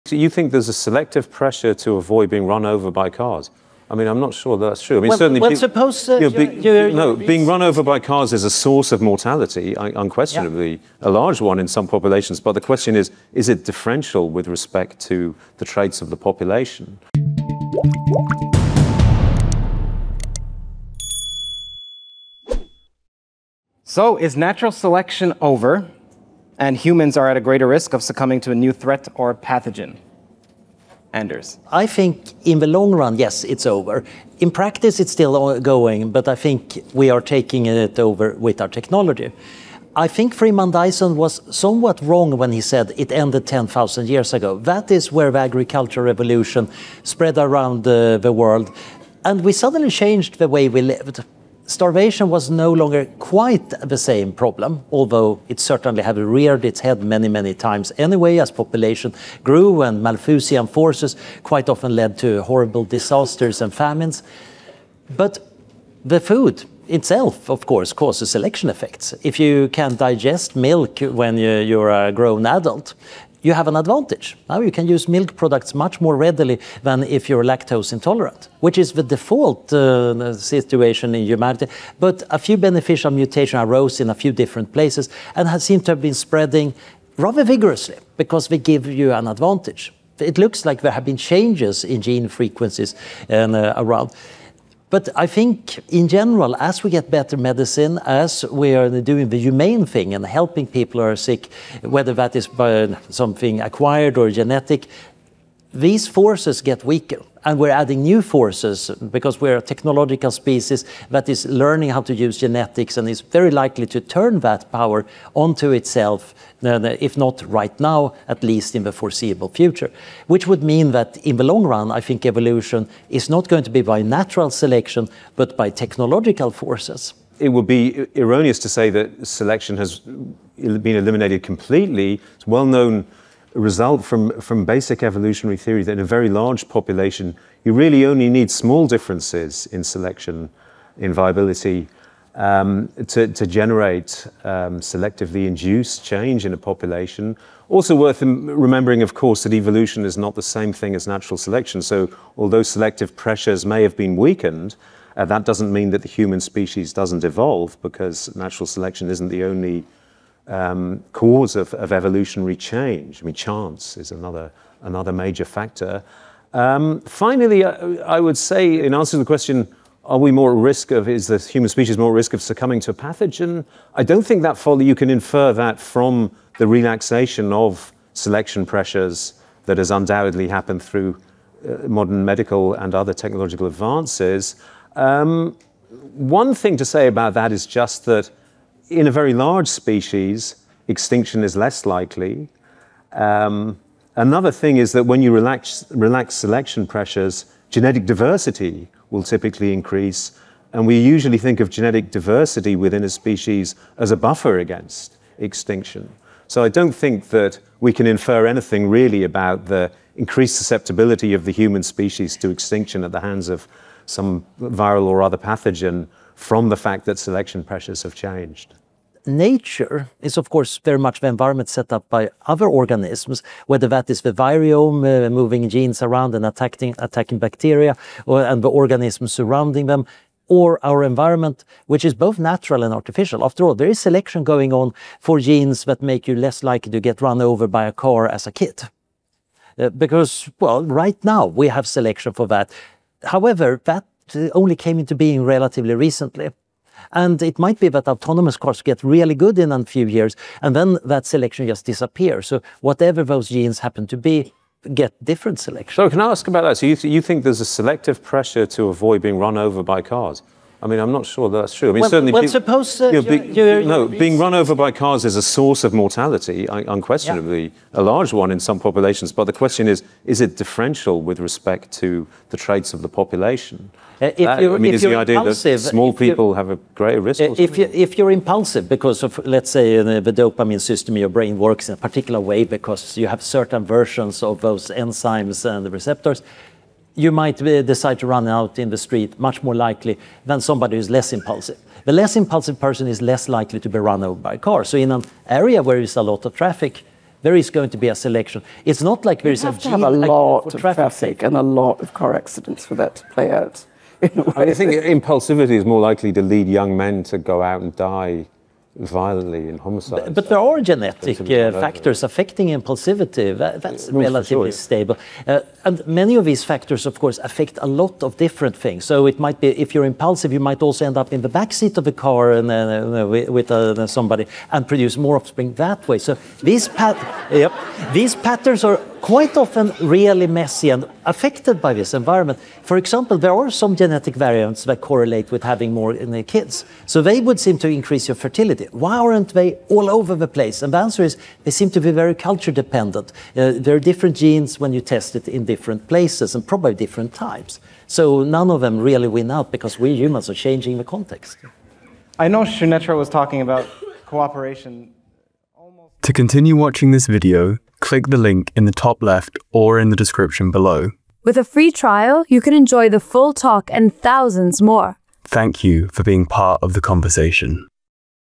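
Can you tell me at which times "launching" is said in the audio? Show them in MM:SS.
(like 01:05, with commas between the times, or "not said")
not said.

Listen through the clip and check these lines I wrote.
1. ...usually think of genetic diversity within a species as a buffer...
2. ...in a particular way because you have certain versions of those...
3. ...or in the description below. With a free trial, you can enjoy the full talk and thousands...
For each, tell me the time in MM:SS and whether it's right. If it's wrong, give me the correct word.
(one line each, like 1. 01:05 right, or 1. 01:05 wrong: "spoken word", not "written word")
1. 03:20 right
2. 04:41 right
3. 05:59 right.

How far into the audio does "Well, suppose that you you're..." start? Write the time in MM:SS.
04:22.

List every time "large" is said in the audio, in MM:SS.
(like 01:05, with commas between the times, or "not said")
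00:11, 02:16, 03:09, 04:28.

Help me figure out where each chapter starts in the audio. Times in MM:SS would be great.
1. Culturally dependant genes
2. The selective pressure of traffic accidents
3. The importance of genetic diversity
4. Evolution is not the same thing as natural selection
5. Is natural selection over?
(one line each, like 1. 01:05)
1. 05:27
2. 03:39
3. 02:49
4. 02:07
5. 00:23.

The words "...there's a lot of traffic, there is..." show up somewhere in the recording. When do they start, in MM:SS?
04:55.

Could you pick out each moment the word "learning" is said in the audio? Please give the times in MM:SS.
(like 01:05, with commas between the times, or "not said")
01:51.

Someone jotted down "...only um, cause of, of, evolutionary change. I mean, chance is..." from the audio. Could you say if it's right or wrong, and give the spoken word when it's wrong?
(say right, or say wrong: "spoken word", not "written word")
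right.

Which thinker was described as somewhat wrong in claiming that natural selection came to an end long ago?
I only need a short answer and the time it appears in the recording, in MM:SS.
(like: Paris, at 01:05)
Freeman Dyson, at 00:40.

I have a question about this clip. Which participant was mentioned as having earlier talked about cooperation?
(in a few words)
Sunetra.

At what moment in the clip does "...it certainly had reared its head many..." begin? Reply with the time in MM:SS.
00:55.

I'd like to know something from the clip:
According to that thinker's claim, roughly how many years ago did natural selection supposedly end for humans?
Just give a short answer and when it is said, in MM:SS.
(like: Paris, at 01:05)
10,000, at 00:43.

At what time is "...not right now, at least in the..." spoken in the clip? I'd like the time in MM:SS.
01:57.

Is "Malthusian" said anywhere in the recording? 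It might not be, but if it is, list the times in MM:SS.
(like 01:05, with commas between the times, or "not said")
01:00.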